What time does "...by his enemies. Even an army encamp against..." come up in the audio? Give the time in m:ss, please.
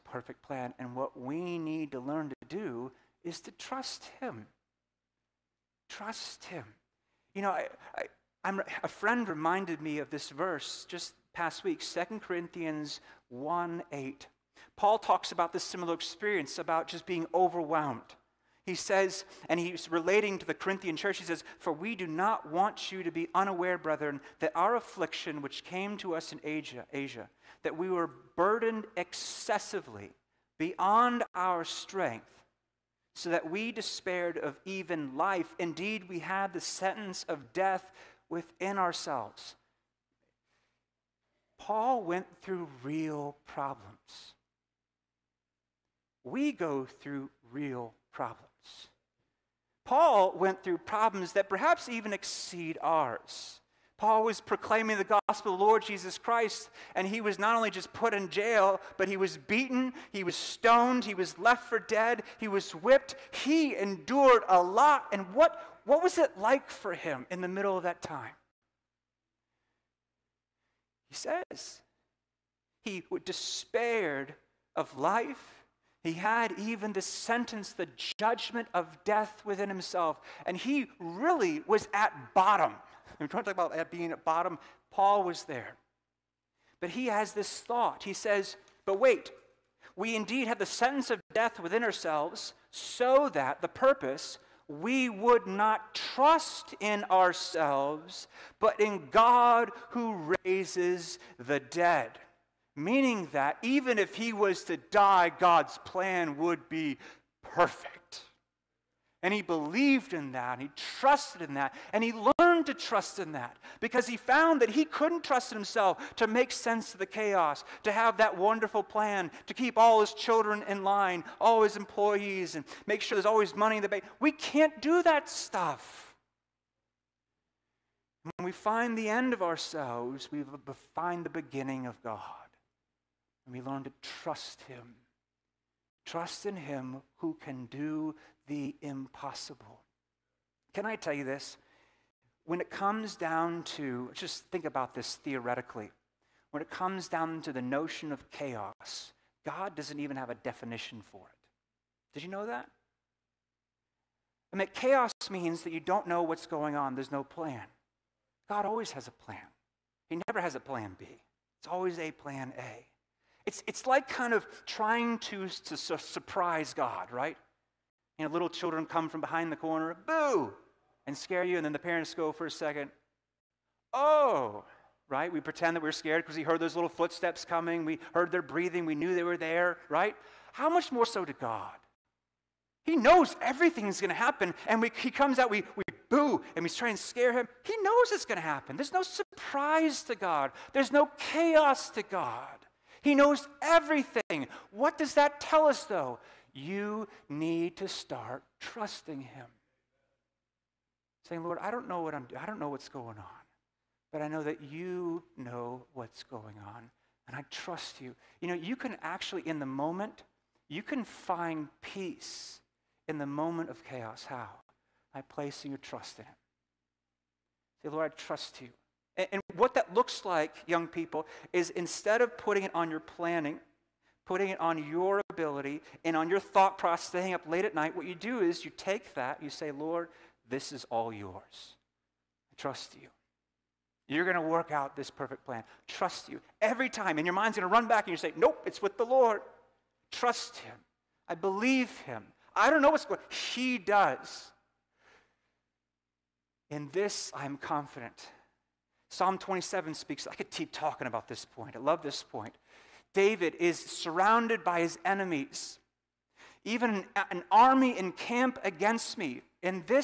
4:14.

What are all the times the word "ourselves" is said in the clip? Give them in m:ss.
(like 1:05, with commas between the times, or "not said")
0:38, 1:31, 1:37, 2:09.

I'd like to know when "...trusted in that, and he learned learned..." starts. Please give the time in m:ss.
1:50.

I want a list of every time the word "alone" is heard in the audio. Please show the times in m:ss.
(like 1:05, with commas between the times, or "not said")
not said.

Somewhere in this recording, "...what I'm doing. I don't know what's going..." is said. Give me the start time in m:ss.
3:22.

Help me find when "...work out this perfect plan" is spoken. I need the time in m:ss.
3:54.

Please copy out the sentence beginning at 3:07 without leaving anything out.
He knows it's going to happen.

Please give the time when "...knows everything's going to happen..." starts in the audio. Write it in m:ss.
3:02.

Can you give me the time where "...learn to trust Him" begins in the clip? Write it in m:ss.
2:13.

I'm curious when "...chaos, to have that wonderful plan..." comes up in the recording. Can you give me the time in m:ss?
1:57.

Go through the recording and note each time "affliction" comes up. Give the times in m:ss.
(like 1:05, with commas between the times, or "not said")
0:24.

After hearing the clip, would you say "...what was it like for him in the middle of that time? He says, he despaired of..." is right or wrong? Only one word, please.
right.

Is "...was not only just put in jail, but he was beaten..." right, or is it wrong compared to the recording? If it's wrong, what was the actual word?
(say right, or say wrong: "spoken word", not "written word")
right.